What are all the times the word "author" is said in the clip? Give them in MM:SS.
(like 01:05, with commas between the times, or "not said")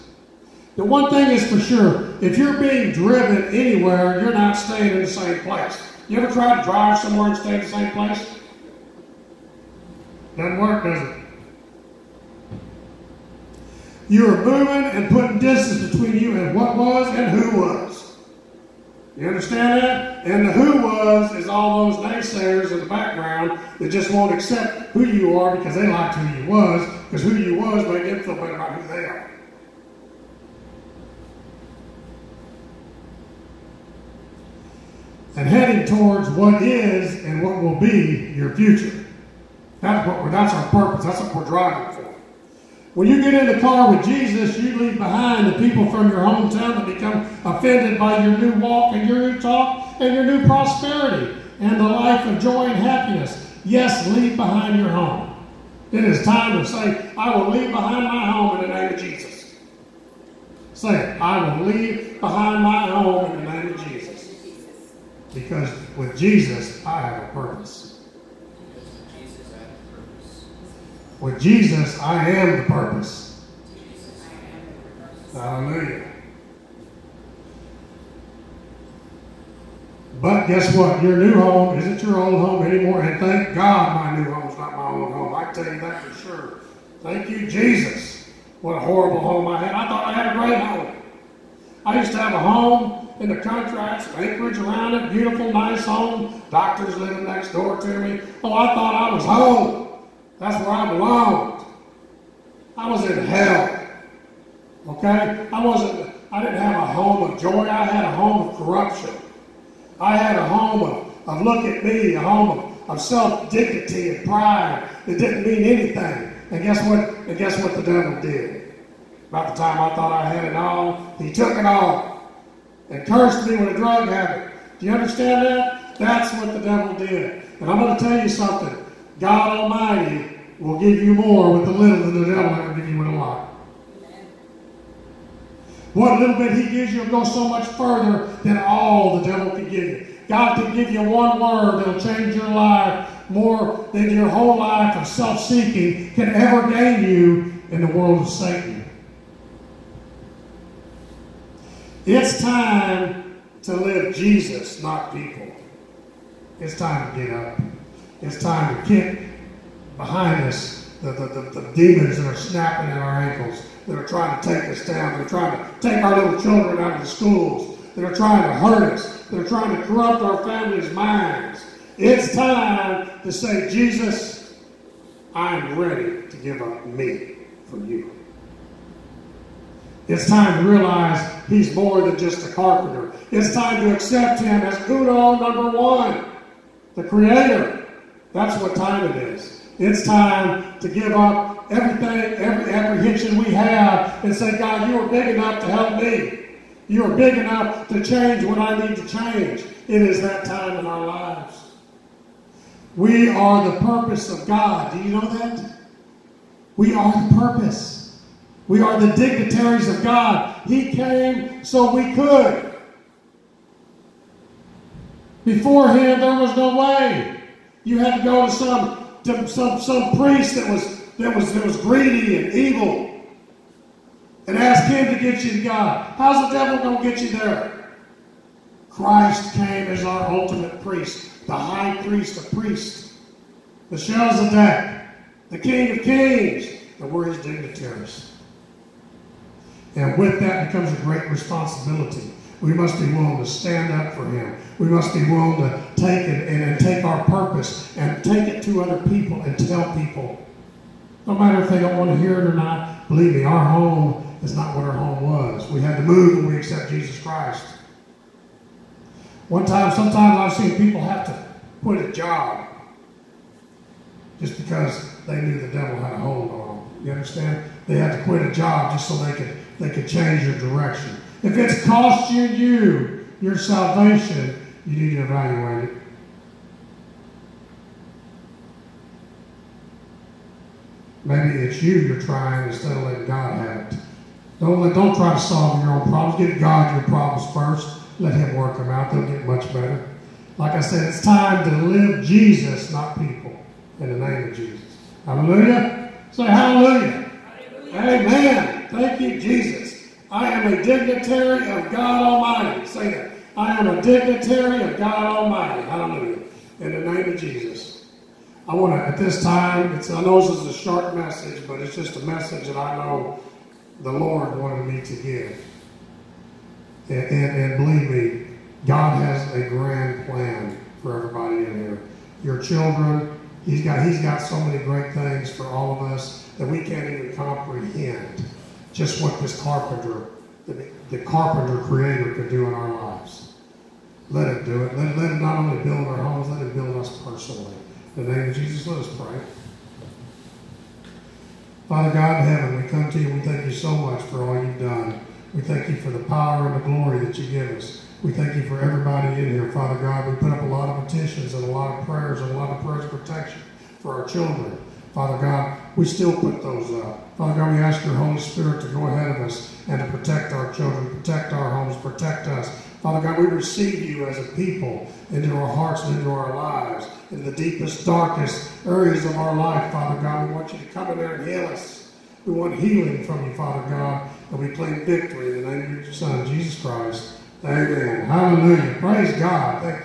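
not said.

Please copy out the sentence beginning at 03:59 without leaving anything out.
And with that becomes a great responsibility.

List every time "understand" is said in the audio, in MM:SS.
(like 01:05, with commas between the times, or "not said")
00:19, 02:04, 04:27.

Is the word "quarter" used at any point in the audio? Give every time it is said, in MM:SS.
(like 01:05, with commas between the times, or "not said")
not said.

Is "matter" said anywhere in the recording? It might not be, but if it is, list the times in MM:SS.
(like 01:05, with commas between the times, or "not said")
04:11.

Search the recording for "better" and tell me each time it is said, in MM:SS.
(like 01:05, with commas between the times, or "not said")
00:28, 04:49.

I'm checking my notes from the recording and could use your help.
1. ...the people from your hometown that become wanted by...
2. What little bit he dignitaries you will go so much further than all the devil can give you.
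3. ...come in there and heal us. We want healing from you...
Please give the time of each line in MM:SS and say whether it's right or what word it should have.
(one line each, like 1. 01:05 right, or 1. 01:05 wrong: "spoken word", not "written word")
1. 00:45 wrong: "offended", not "wanted"
2. 02:15 wrong: "gives", not "dignitaries"
3. 06:10 right.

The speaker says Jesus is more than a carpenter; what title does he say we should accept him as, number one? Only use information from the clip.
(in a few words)
The creator.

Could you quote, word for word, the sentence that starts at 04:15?
We had to move when we accept Jesus Christ.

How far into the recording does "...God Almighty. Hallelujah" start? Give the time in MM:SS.
05:04.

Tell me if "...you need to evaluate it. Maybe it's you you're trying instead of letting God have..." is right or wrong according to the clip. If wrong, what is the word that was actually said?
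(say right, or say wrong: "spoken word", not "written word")
right.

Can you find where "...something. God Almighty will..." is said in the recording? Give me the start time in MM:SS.
02:08.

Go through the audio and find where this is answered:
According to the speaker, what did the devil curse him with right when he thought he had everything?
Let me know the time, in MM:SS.
02:03.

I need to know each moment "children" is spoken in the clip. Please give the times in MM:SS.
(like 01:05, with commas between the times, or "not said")
02:46, 05:22, 05:54, 06:00.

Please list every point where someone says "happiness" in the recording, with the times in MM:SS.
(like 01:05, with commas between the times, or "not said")
00:52.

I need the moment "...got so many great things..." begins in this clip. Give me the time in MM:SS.
05:24.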